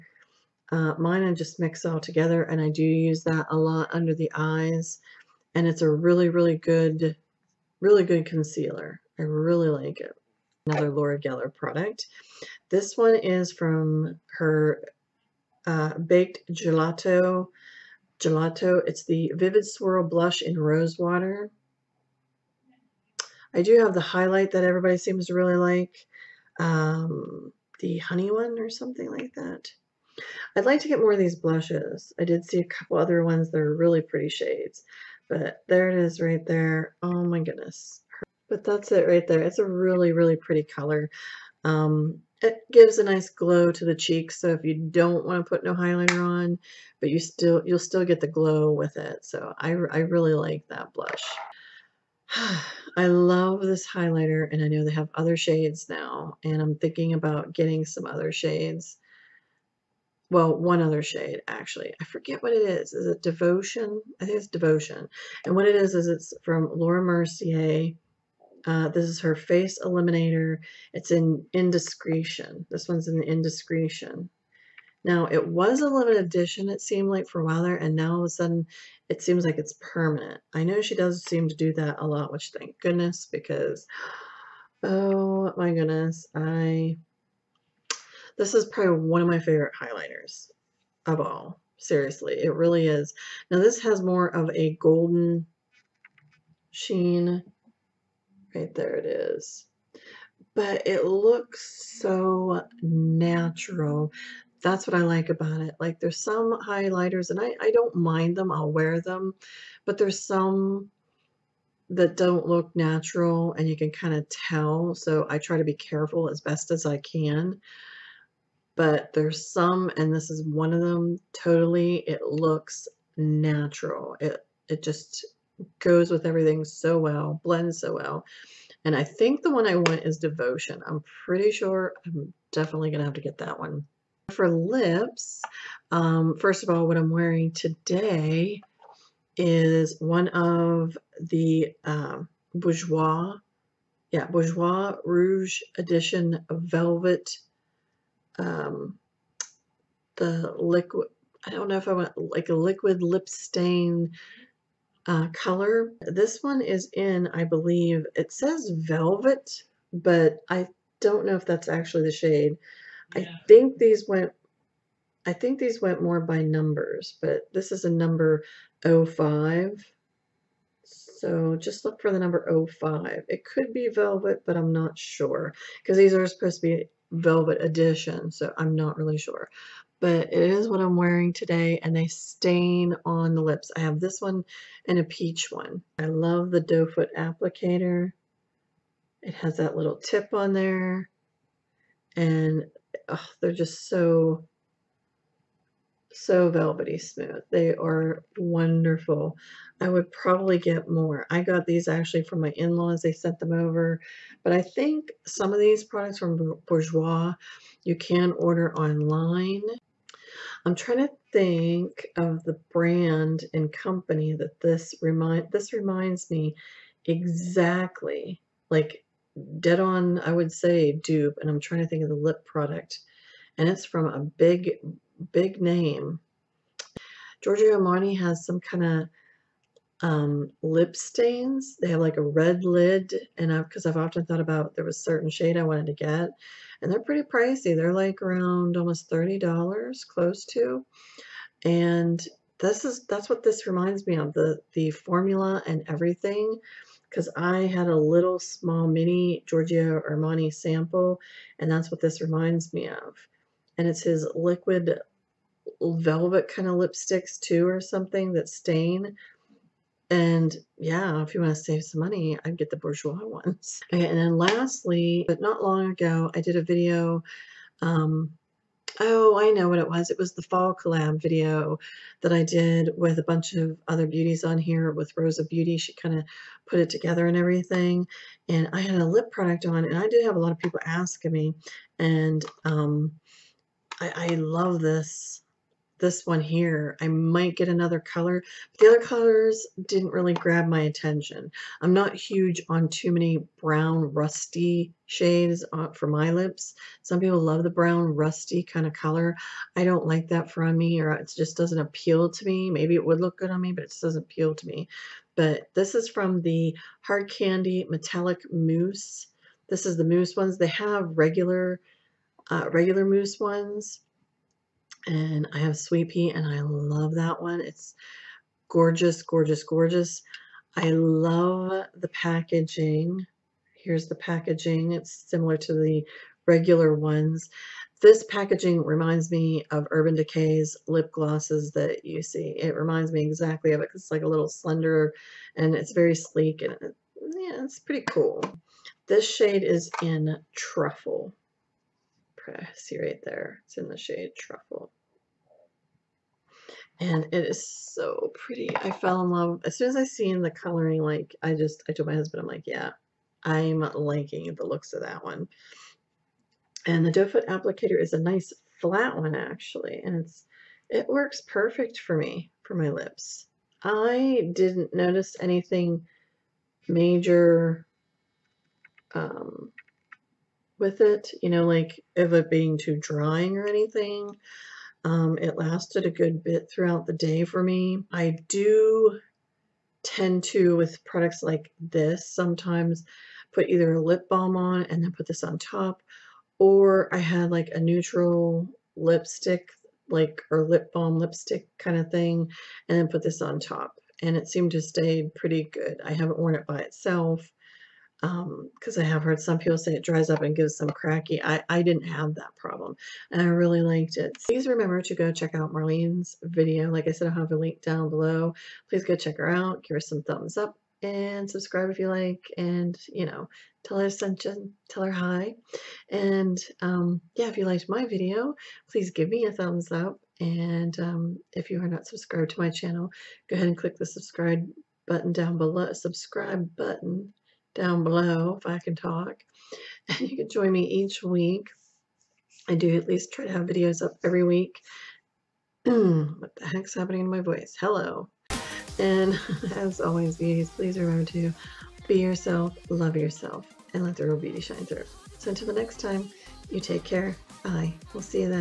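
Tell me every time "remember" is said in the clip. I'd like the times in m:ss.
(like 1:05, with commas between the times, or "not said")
6:44, 7:20.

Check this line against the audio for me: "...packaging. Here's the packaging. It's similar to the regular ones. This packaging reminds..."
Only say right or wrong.
right.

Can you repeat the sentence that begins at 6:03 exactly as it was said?
I didn't notice anything major um, with it, you know, like of it being too drying or anything.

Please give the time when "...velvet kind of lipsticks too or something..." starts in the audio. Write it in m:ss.
4:15.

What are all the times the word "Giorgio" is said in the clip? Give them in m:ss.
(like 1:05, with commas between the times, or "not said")
3:47, 4:09.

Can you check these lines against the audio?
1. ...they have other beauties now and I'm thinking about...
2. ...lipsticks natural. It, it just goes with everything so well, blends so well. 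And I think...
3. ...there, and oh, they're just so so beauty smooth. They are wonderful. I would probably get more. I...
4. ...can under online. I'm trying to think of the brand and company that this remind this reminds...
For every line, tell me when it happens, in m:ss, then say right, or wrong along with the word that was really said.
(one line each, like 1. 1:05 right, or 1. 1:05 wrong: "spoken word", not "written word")
1. 0:54 wrong: "shades", not "beauties"
2. 2:02 wrong: "looks", not "lipsticks"
3. 3:10 wrong: "velvety", not "beauty"
4. 3:27 wrong: "order", not "under".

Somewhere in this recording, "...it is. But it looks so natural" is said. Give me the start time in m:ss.
1:38.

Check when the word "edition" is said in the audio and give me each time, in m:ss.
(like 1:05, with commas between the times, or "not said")
1:16, 2:25, 2:57.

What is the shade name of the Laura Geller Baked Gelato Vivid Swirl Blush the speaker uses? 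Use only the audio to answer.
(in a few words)
Rose Water.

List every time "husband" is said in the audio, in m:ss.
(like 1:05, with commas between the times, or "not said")
5:52.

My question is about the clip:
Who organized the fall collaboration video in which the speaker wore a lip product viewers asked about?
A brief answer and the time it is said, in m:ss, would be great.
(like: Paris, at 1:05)
Rosa Beauty, at 4:35.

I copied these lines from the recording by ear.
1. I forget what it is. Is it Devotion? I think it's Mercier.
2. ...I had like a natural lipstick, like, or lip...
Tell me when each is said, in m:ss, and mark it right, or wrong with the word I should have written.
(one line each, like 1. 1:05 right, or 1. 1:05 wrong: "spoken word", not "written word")
1. 1:01 wrong: "Devotion", not "Mercier"
2. 6:27 wrong: "neutral", not "natural".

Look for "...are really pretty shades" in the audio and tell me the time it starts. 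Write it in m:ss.
0:33.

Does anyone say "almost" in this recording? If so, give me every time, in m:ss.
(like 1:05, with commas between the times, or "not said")
3:58.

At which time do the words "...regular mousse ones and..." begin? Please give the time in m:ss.
5:12.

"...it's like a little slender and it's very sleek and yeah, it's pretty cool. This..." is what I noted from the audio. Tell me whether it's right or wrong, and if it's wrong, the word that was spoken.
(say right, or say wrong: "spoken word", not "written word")
right.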